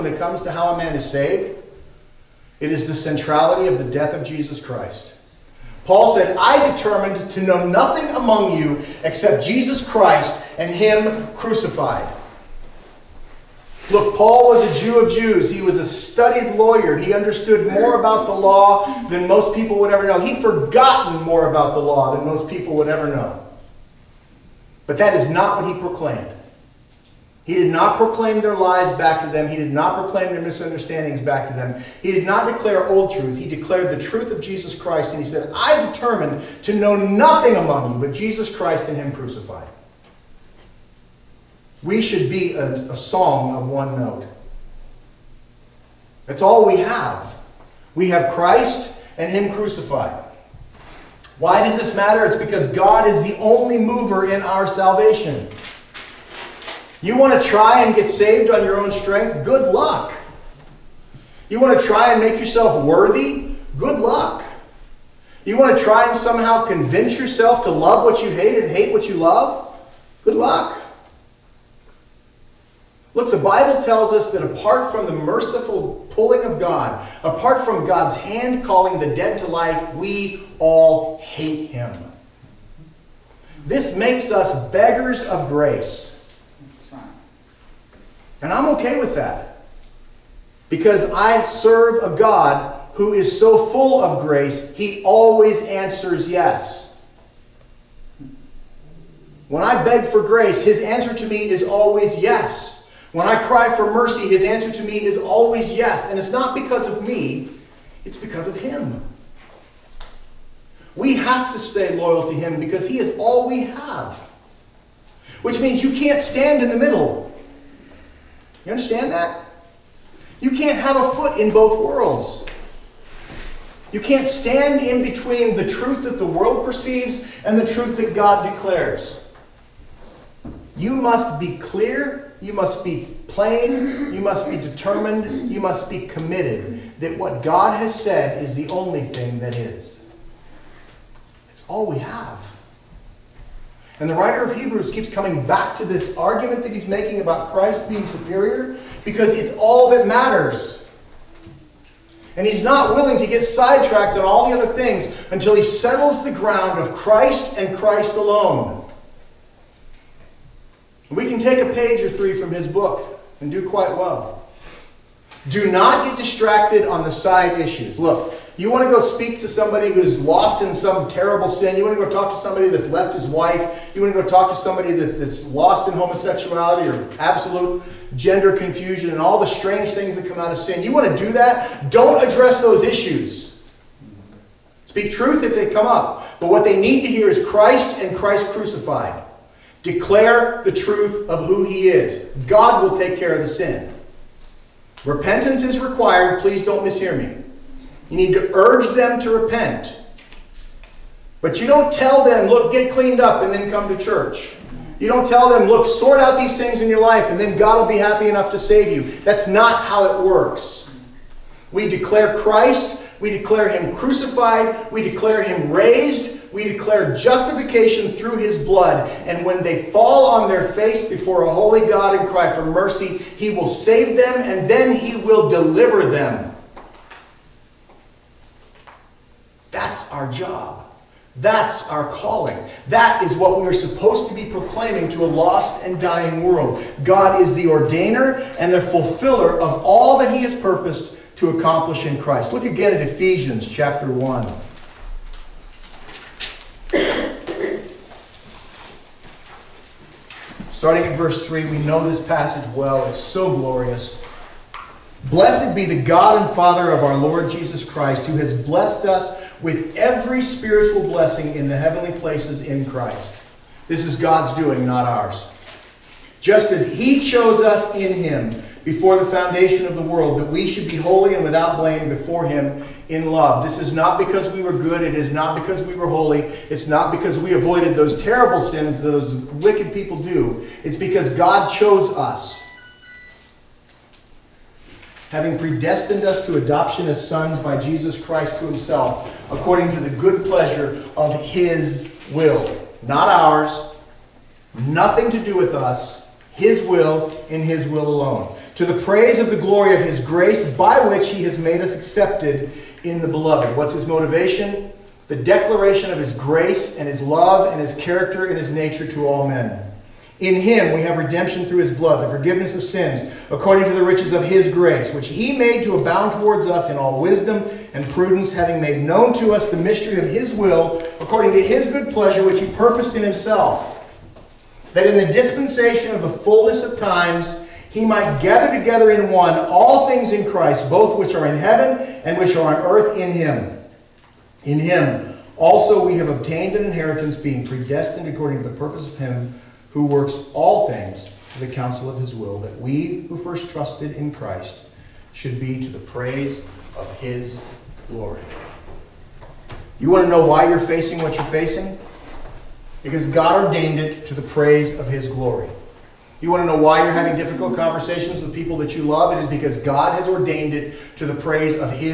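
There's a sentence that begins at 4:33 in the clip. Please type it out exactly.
This is not because we were good.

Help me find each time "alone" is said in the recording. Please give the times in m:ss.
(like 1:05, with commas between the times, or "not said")
2:38, 4:58.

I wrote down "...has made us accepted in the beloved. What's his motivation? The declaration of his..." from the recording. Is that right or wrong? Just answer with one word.
right.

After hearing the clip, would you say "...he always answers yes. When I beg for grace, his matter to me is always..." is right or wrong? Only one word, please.
wrong.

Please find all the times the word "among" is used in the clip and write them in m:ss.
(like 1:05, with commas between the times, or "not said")
0:08, 0:37.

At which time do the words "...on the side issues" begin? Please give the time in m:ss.
2:46.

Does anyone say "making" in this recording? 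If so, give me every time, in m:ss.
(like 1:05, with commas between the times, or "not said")
2:26.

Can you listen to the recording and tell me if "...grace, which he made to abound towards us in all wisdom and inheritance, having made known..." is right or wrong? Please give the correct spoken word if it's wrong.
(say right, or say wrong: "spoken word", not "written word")
wrong: "prudence", not "inheritance".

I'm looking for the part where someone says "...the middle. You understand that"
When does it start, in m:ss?
1:56.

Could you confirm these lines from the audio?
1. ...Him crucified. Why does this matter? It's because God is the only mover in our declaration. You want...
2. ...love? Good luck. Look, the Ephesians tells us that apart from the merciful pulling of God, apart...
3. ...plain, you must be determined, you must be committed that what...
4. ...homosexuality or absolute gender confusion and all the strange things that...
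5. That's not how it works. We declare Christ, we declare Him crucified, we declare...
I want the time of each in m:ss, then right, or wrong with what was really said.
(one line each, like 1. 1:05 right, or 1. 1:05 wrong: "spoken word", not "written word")
1. 0:49 wrong: "salvation", not "declaration"
2. 1:09 wrong: "Bible", not "Ephesians"
3. 2:13 right
4. 2:55 right
5. 3:29 right.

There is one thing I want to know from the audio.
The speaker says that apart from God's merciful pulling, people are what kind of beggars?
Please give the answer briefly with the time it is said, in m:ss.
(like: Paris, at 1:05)
beggars of grace, at 1:24.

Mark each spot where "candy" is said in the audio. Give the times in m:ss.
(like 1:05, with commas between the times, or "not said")
not said.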